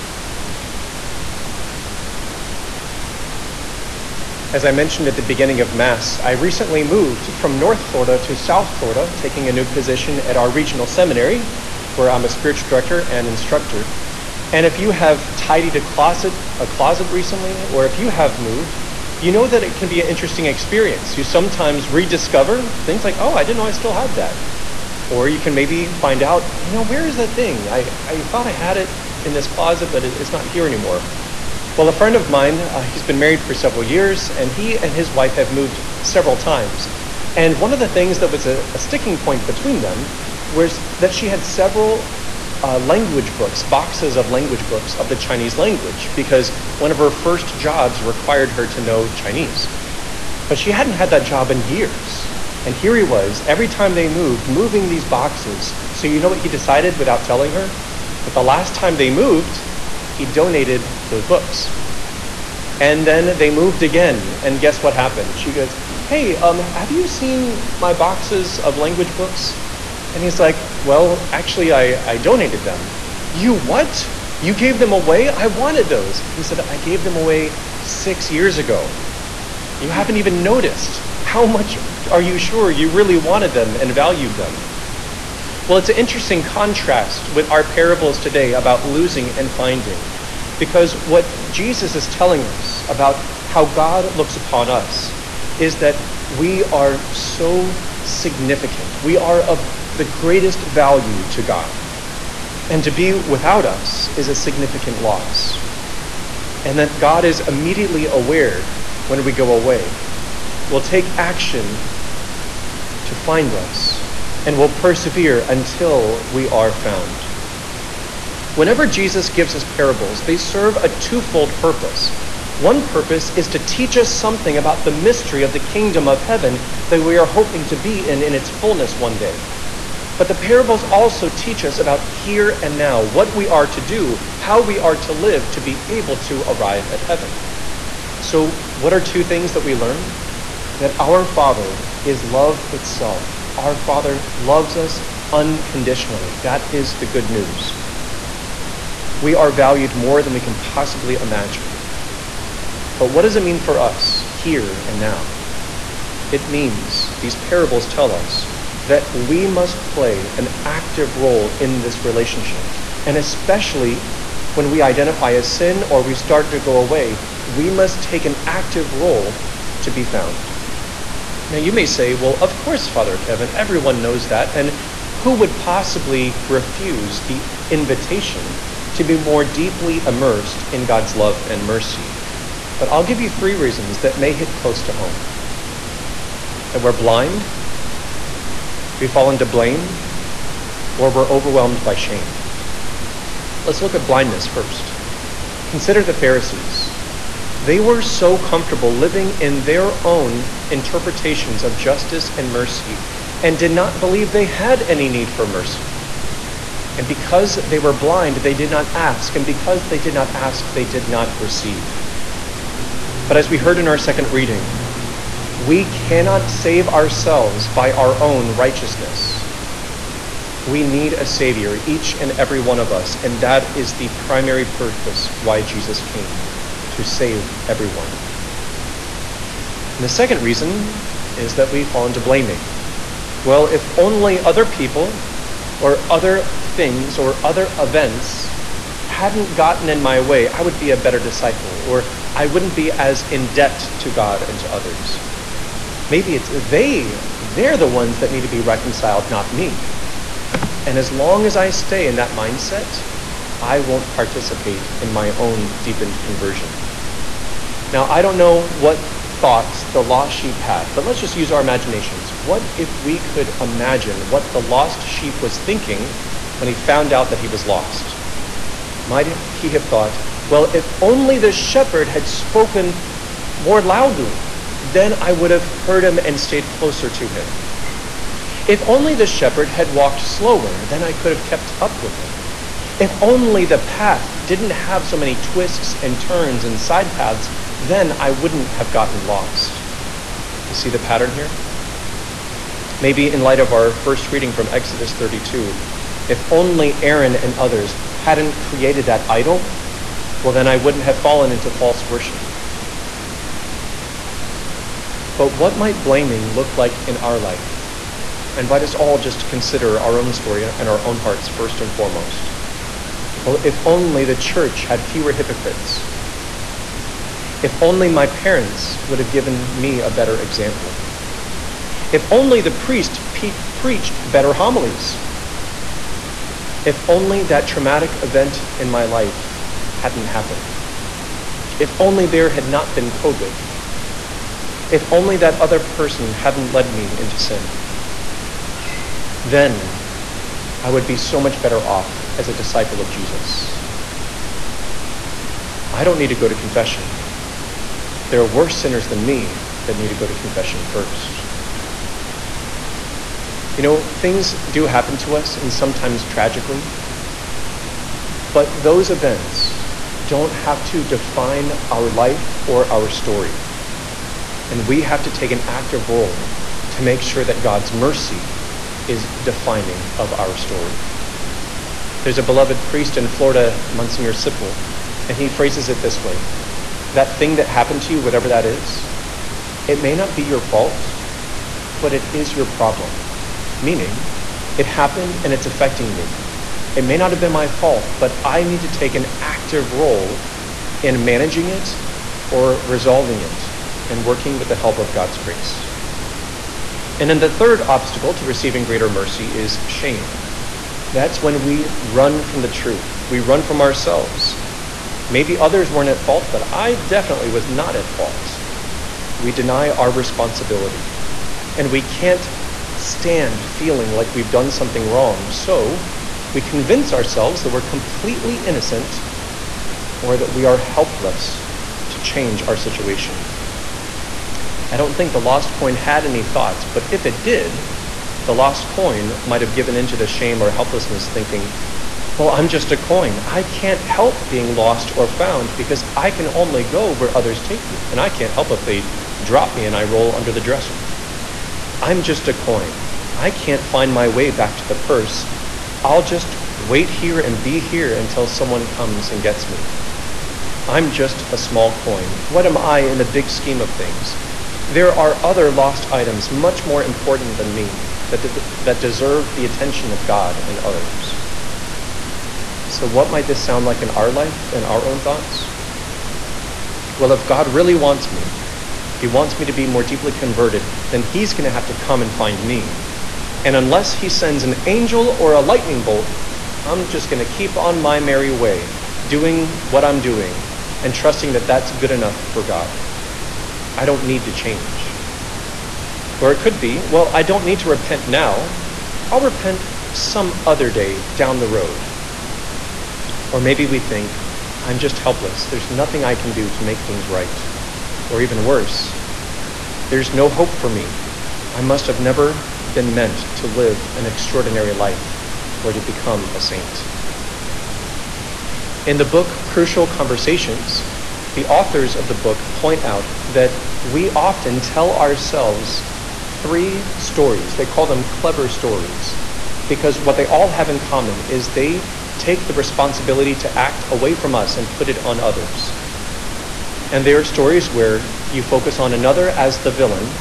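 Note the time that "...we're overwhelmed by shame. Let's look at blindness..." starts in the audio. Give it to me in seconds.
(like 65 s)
191 s.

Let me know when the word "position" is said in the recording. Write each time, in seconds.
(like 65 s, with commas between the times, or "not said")
9 s.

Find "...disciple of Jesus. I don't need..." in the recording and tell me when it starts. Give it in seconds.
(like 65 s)
342 s.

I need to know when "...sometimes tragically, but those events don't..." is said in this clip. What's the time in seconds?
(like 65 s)
355 s.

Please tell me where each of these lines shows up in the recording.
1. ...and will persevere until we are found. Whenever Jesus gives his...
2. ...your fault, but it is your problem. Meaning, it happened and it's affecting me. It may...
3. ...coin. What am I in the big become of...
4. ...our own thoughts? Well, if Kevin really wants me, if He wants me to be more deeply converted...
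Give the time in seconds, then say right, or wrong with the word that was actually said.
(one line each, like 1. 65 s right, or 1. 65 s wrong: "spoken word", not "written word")
1. 114 s right
2. 380 s right
3. 452 s wrong: "scheme", not "become"
4. 464 s wrong: "God", not "Kevin".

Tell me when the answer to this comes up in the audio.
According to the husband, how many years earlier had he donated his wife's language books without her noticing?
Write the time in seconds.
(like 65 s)
77 s.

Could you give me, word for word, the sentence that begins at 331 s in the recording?
If only there had not been COVID.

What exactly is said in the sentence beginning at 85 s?
Well, it's an interesting contrast with our parables today about losing and finding.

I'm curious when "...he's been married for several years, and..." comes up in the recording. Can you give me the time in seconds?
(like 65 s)
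32 s.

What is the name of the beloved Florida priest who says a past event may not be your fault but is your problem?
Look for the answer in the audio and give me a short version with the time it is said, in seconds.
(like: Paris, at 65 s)
Monsignor Sipple, at 373 s.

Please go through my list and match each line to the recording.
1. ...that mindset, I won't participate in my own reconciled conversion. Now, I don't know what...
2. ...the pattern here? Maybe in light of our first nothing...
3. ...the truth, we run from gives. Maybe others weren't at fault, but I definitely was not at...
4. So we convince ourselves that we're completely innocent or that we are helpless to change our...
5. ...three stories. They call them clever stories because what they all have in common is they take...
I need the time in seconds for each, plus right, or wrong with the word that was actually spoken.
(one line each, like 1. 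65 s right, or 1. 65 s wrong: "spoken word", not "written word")
1. 252 s wrong: "deepened", not "reconciled"
2. 290 s wrong: "reading", not "nothing"
3. 402 s wrong: "ourselves", not "gives"
4. 415 s right
5. 516 s right.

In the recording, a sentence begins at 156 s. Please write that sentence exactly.
It means, these parables tell us, that we must play an active role in this relationship.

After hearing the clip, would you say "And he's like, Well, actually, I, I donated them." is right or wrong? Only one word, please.
right.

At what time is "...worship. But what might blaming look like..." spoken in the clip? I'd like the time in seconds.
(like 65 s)
302 s.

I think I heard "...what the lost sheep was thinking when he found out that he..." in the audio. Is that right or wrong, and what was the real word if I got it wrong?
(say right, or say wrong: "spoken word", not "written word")
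right.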